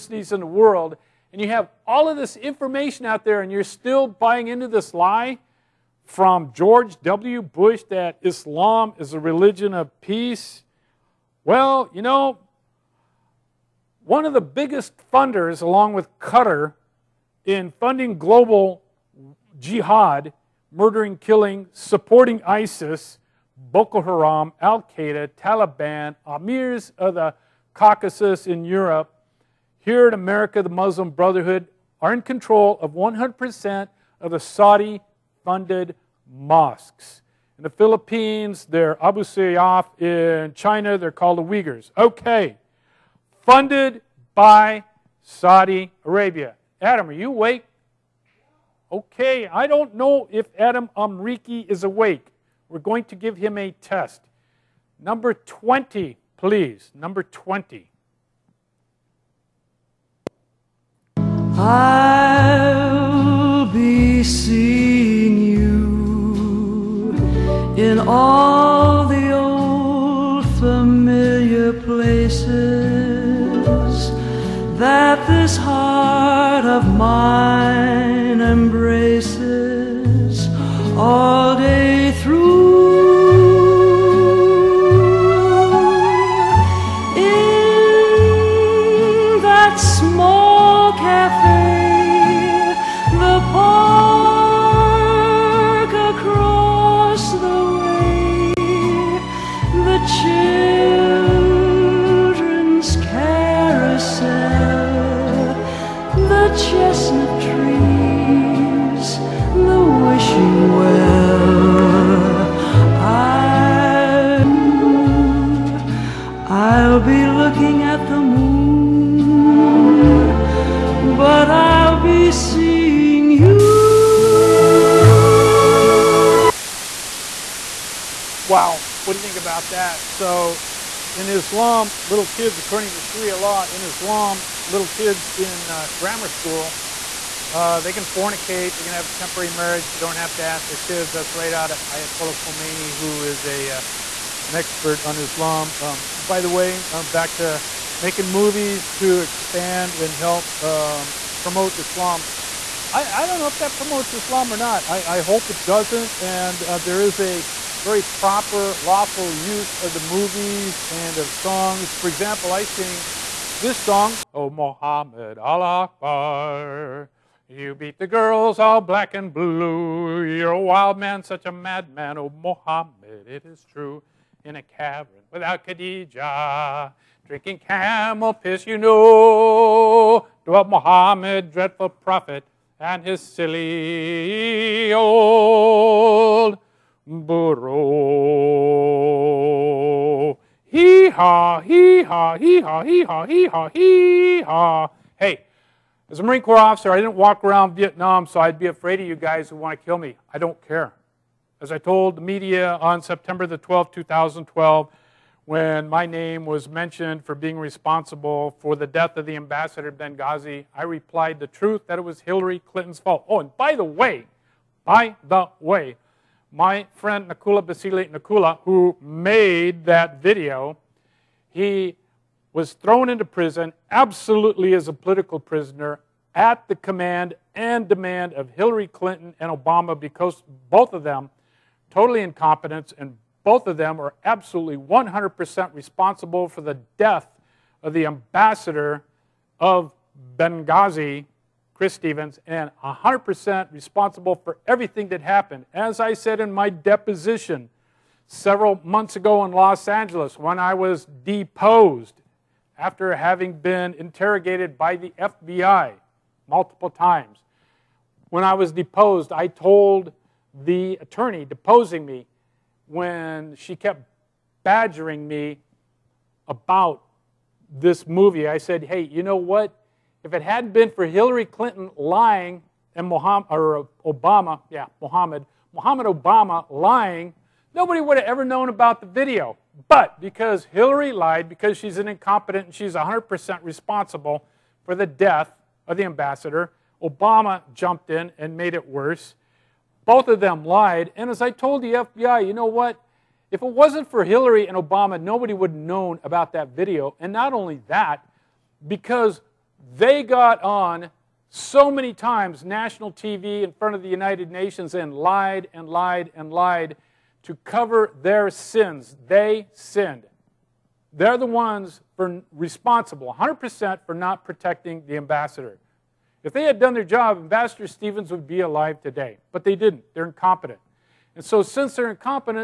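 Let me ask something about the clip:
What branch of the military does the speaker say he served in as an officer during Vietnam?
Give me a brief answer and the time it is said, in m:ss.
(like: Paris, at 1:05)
Marine Corps, at 3:16.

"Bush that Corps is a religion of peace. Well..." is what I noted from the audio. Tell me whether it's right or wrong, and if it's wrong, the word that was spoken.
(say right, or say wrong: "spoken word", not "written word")
wrong: "Islam", not "Corps".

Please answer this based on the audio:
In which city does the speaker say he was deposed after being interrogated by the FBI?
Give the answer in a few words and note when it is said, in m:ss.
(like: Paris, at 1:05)
Los Angeles, at 4:09.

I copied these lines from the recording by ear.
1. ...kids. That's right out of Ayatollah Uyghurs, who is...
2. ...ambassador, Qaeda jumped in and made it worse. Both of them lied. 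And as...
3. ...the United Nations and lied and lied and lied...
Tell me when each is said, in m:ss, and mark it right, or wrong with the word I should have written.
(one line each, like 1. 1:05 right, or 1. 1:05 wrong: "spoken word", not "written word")
1. 2:20 wrong: "Khomeini", not "Uyghurs"
2. 4:46 wrong: "Obama", not "Qaeda"
3. 5:04 right.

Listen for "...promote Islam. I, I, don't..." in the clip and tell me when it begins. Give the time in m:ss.
2:31.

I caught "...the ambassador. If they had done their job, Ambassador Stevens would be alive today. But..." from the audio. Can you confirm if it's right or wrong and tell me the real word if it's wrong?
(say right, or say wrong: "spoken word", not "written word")
right.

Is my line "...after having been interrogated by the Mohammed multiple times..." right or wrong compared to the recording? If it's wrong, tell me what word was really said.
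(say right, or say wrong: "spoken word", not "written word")
wrong: "FBI", not "Mohammed".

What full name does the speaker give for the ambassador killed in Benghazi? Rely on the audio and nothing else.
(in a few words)
Chris Stevens.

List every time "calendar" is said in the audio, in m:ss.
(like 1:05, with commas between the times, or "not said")
not said.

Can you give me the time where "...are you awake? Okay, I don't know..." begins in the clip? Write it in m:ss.
0:47.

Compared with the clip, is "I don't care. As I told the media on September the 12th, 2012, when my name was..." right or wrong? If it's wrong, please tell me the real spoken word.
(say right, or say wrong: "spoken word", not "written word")
right.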